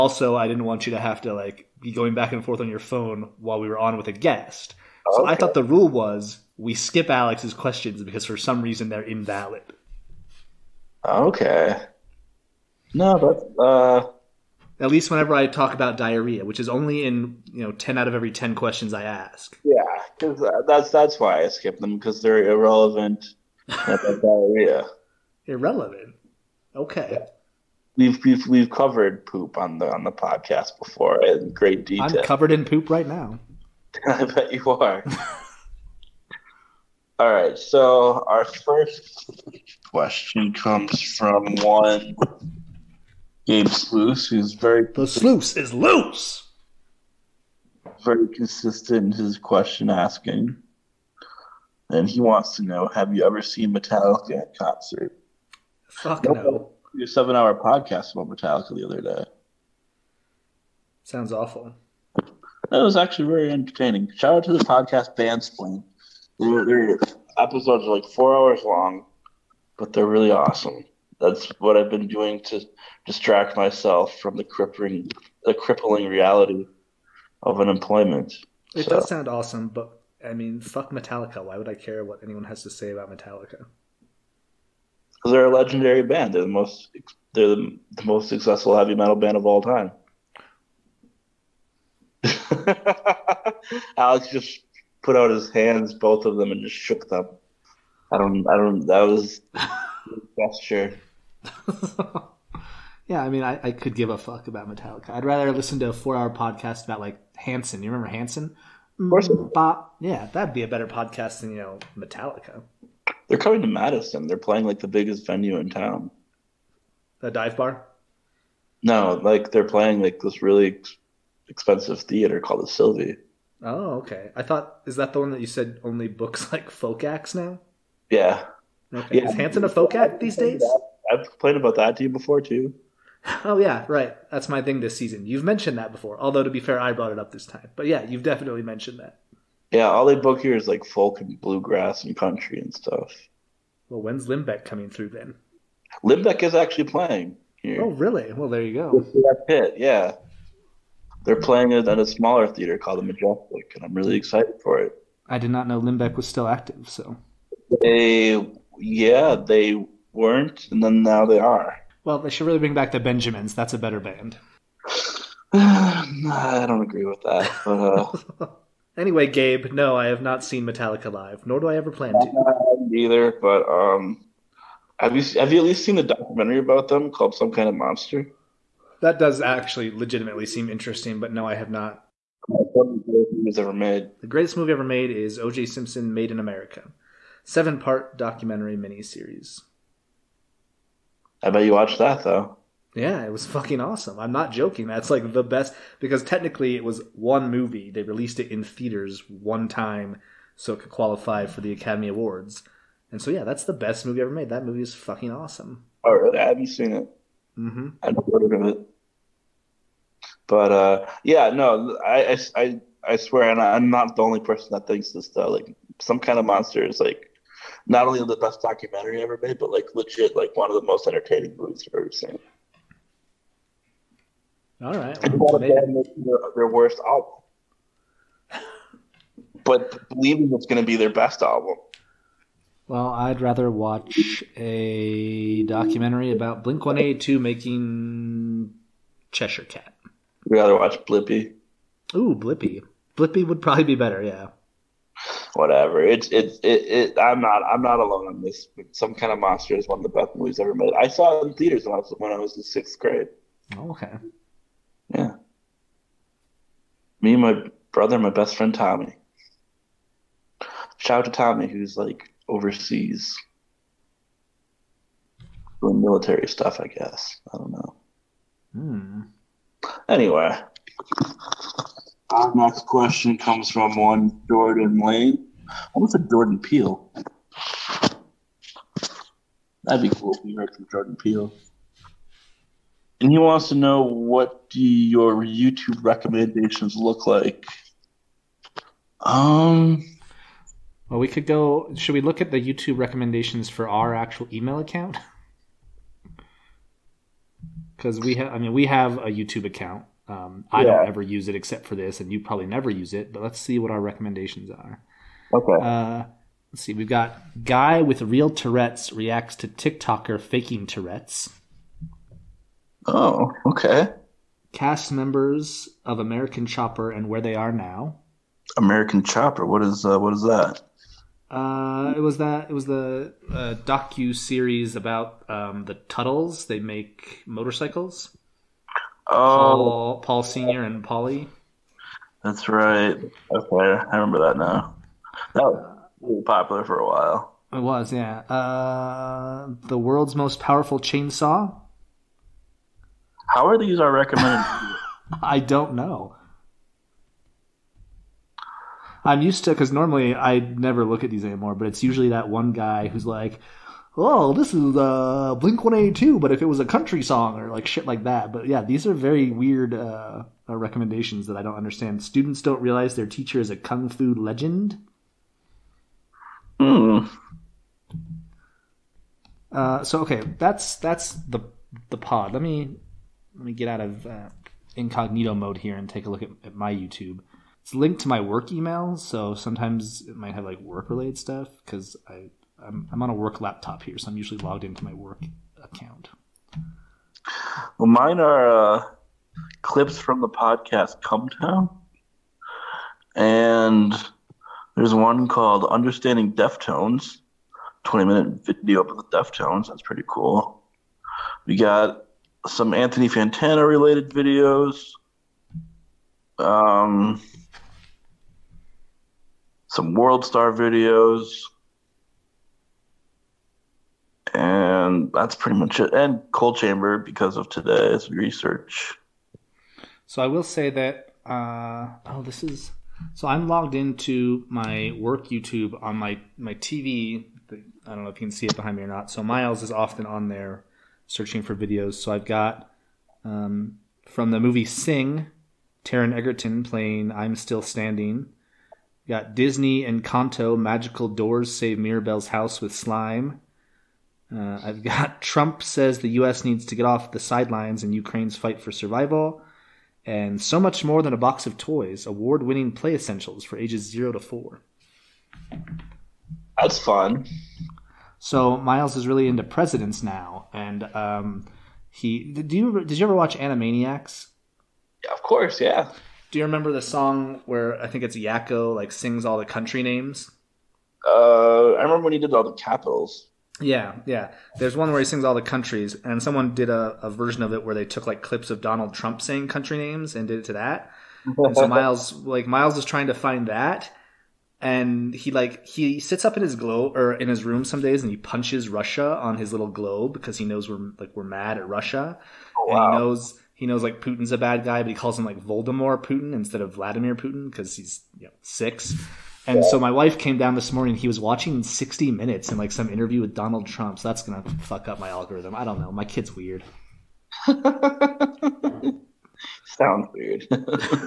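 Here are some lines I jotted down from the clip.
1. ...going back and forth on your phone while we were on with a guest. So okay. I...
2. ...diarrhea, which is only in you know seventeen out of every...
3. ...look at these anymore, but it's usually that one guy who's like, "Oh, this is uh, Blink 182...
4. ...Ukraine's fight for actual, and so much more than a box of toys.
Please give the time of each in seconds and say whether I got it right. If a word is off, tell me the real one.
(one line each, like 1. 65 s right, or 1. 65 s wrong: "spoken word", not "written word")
1. 1 s right
2. 15 s wrong: "ten", not "seventeen"
3. 351 s right
4. 448 s wrong: "survival", not "actual".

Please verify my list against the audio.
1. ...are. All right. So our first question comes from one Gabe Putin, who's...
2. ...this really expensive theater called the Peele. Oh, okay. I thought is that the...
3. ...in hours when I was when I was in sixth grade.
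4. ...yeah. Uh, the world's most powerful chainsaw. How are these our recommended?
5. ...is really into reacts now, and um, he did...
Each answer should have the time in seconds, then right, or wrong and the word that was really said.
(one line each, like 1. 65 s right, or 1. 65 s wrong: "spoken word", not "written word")
1. 34 s wrong: "Sluice", not "Putin"
2. 120 s wrong: "Sylvee", not "Peele"
3. 251 s wrong: "theaters", not "hours"
4. 338 s right
5. 459 s wrong: "presidents", not "reacts".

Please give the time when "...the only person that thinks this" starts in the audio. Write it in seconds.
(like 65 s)
214 s.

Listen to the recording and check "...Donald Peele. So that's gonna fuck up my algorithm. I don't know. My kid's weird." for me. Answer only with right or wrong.
wrong.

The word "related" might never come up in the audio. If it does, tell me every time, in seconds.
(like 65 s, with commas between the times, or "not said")
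381 s, 403 s.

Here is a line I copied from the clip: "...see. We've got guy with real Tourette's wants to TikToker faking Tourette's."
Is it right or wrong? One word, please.
wrong.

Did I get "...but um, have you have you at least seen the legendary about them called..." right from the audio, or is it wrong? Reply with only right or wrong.
wrong.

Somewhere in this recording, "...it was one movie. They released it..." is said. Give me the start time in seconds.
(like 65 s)
196 s.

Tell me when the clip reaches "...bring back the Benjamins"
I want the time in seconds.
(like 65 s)
162 s.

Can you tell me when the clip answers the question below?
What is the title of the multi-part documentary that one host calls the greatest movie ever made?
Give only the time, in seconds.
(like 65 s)
185 s.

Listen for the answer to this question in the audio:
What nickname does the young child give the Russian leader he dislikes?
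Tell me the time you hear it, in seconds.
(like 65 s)
495 s.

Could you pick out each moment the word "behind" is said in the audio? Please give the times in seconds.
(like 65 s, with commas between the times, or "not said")
428 s.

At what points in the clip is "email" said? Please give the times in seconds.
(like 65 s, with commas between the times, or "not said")
294 s, 378 s.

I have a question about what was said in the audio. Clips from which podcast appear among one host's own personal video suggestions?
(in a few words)
Come Town.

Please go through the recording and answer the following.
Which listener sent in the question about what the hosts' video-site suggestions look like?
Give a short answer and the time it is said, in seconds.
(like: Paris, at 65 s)
Jordan Lane, at 274 s.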